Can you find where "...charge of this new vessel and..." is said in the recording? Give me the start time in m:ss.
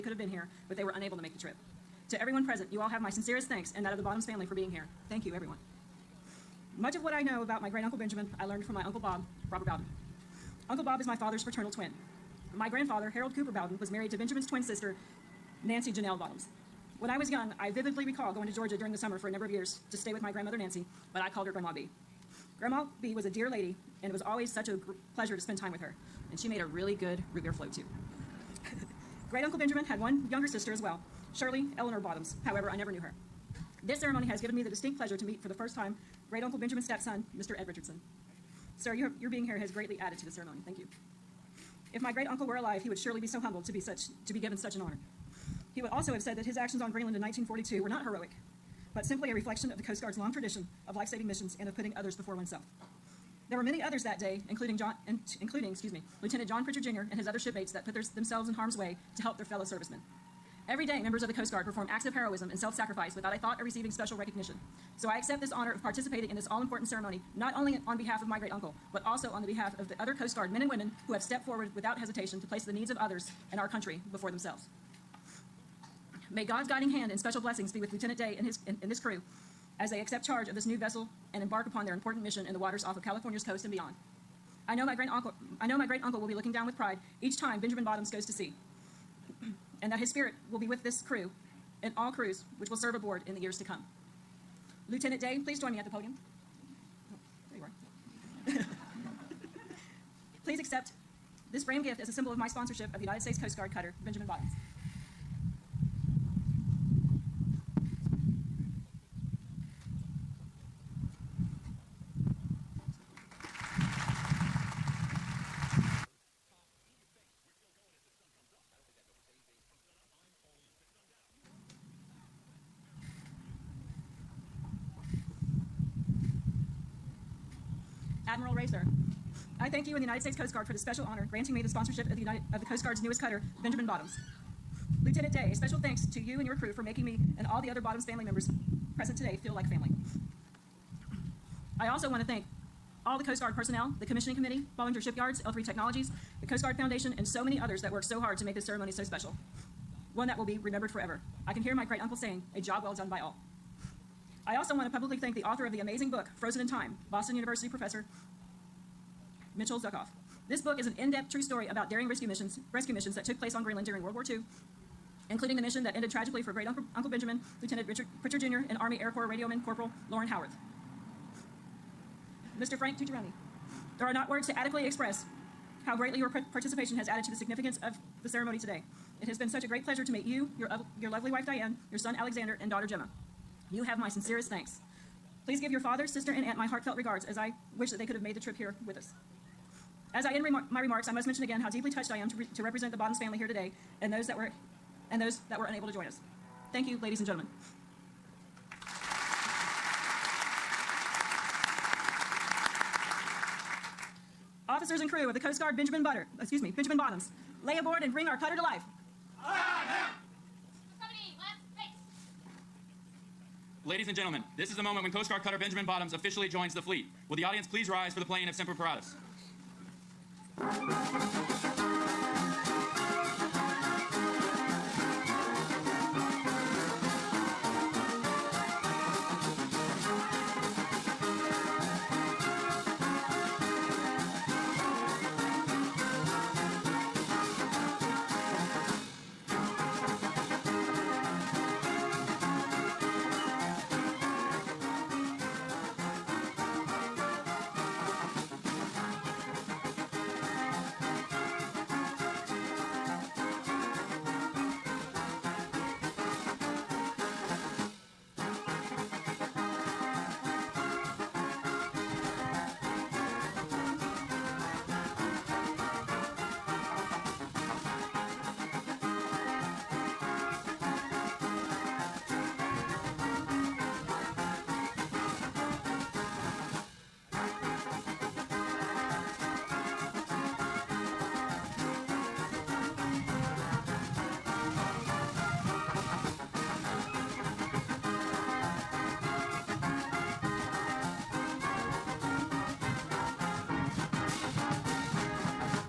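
1:20.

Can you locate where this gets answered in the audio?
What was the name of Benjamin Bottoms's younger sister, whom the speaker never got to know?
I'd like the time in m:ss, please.
0:31.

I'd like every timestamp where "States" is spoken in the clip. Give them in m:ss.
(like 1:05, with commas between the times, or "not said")
1:43, 2:10.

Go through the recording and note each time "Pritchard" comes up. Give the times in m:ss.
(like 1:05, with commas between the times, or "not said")
0:56, 2:48.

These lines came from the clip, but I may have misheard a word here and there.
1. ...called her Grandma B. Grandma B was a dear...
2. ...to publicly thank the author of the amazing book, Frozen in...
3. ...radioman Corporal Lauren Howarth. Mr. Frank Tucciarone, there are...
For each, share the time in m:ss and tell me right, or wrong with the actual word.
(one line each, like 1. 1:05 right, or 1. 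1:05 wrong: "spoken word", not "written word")
1. 0:21 right
2. 2:34 right
3. 2:49 right.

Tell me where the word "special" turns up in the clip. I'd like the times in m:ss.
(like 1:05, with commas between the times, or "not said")
1:03, 1:17, 2:10, 2:15, 2:29.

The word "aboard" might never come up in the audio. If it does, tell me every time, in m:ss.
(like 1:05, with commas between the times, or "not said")
1:32, 3:27.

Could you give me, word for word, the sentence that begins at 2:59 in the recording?
It has been such a great pleasure to meet you, your, your lovely wife Diane, your son Alexander, and daughter Gemma.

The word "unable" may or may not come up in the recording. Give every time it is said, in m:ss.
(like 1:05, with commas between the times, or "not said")
0:00, 3:15.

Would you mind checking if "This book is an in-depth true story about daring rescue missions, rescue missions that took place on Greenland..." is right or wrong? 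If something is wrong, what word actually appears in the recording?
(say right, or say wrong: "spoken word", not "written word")
right.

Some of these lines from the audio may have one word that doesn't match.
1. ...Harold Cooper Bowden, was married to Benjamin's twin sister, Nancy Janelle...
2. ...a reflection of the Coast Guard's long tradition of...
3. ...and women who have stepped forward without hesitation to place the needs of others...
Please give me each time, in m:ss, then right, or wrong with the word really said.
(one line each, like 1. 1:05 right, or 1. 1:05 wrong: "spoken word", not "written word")
1. 0:13 right
2. 0:49 right
3. 1:10 right.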